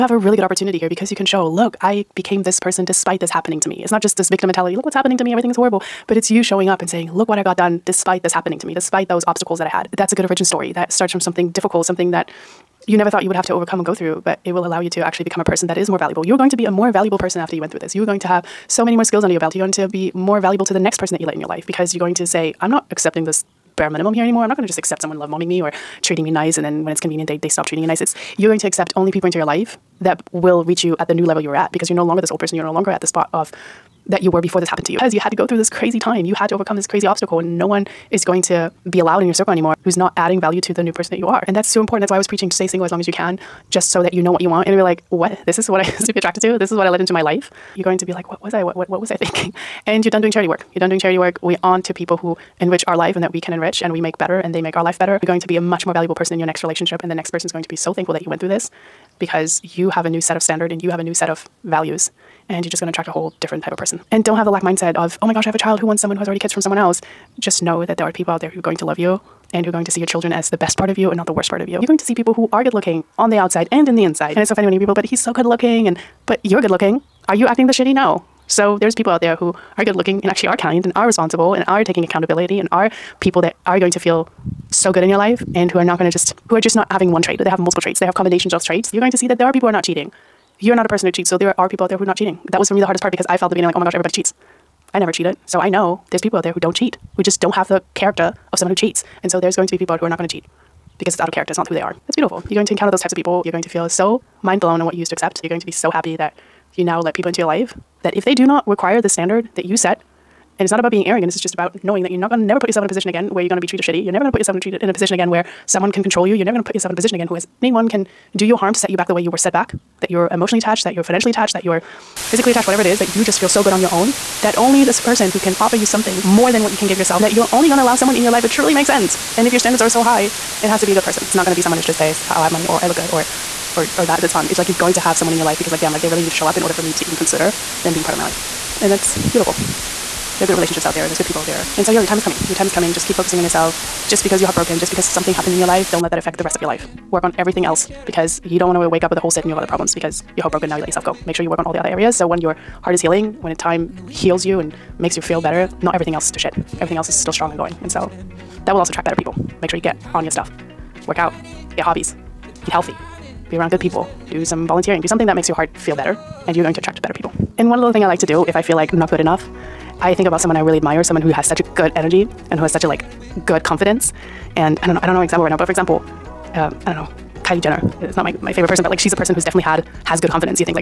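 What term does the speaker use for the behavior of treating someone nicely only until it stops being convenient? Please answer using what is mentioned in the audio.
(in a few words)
love bombing.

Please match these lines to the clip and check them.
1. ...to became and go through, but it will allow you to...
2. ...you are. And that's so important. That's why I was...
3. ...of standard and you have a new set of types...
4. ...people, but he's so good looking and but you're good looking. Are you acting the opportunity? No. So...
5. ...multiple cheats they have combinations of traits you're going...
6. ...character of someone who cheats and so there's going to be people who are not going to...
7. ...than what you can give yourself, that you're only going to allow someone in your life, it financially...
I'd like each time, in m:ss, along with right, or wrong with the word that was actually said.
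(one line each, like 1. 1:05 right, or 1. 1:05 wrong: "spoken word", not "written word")
1. 0:13 wrong: "overcome", not "became"
2. 0:41 right
3. 1:00 wrong: "values", not "types"
4. 1:14 wrong: "shitty", not "opportunity"
5. 1:27 wrong: "traits", not "cheats"
6. 1:37 right
7. 2:06 wrong: "truly", not "financially".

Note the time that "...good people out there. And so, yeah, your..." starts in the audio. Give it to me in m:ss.
2:21.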